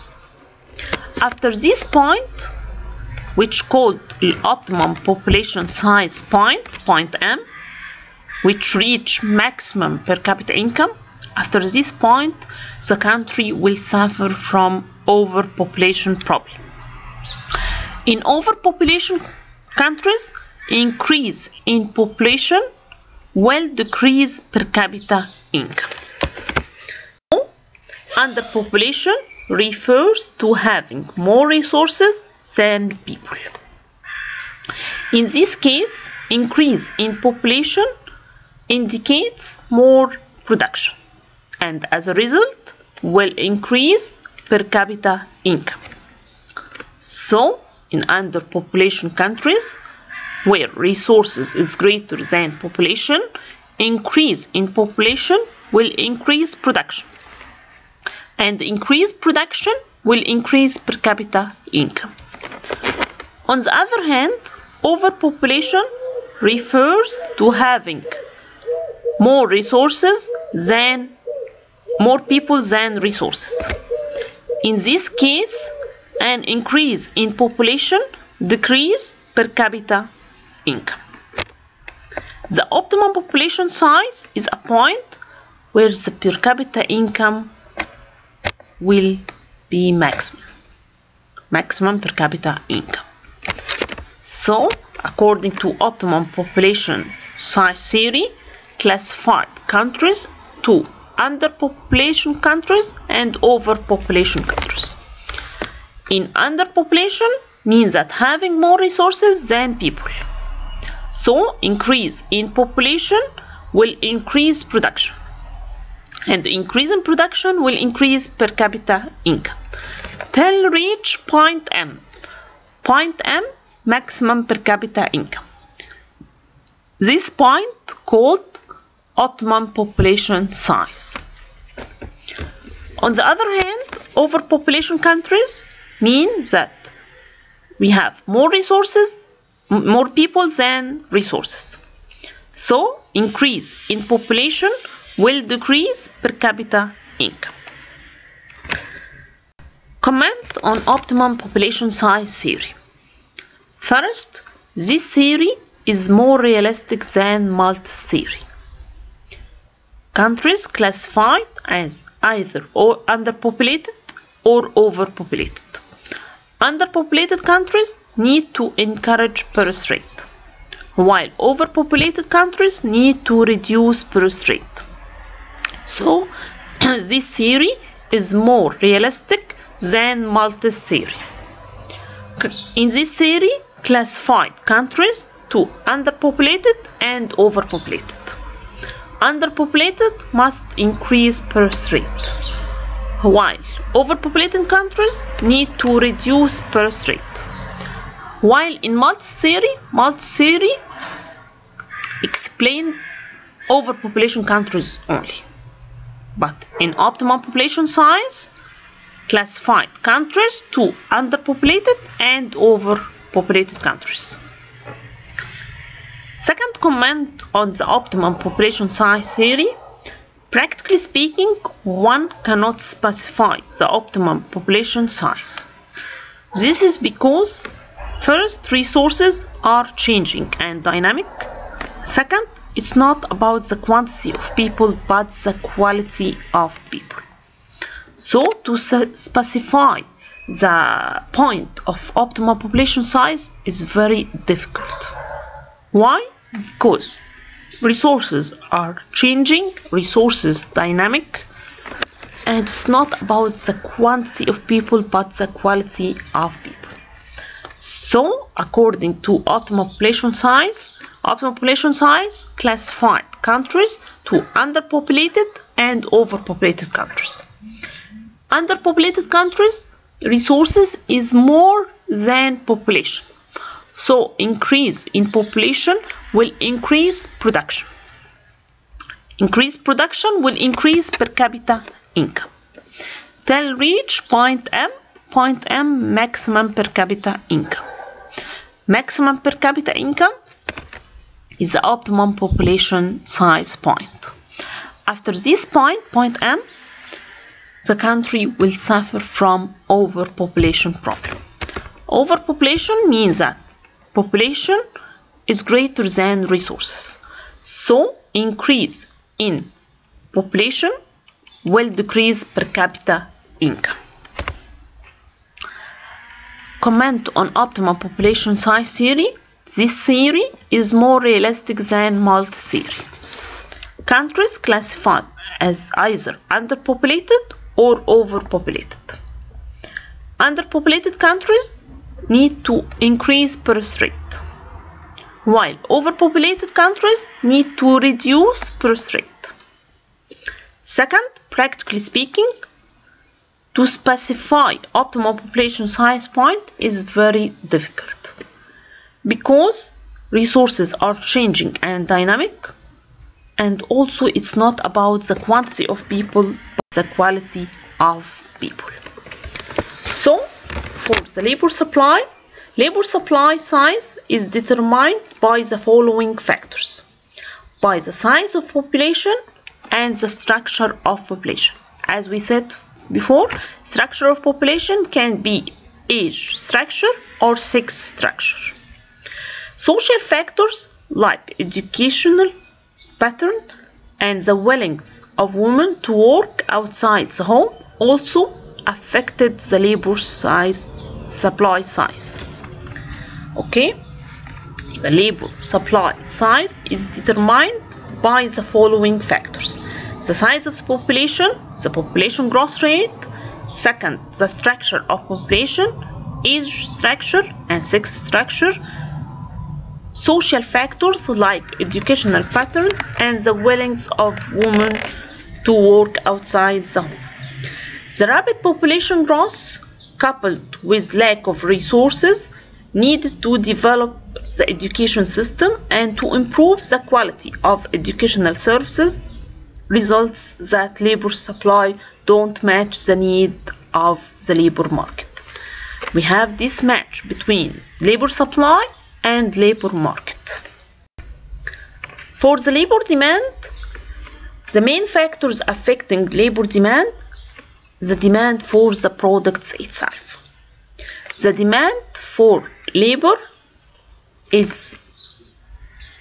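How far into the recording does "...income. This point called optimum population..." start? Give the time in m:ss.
2:05.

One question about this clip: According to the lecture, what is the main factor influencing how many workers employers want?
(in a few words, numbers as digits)
demand for the products.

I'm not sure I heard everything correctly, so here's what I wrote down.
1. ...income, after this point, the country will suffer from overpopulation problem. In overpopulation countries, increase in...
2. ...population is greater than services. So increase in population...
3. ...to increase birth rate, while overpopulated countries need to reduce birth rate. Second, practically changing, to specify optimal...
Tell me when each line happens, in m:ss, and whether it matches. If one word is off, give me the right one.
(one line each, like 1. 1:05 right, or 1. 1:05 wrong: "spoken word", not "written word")
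1. 0:10 right
2. 5:04 wrong: "resources", not "services"
3. 5:32 wrong: "speaking", not "changing".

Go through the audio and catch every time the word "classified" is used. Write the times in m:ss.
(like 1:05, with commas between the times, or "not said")
1:38, 2:40, 3:03, 3:29, 4:22, 5:24.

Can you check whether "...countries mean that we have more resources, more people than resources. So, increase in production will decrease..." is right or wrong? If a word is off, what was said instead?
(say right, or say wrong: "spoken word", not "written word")
wrong: "population", not "production".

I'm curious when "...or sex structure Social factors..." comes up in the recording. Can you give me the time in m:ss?
6:17.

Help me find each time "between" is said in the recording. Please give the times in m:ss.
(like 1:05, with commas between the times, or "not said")
7:17.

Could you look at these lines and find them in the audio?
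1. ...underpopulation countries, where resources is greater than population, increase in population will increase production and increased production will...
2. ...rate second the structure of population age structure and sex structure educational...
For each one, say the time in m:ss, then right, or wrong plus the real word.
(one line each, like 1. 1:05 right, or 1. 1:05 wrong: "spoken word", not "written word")
1. 0:48 right
2. 6:42 wrong: "social", not "educational".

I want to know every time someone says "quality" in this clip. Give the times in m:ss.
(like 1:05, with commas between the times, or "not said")
3:55, 4:15, 5:57, 7:06.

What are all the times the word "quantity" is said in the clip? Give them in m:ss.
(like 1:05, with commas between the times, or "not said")
3:53, 4:13, 5:55.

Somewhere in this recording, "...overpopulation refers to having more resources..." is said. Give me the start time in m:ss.
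1:04.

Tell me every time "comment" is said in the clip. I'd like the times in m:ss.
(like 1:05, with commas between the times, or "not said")
2:29, 3:36, 5:16.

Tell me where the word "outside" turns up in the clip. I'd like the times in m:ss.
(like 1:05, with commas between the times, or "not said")
6:26, 6:56.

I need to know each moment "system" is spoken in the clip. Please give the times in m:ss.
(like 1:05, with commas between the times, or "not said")
7:05.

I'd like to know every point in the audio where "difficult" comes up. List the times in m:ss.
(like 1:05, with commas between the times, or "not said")
4:04, 5:47.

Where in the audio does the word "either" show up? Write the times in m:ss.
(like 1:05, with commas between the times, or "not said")
2:42, 5:25.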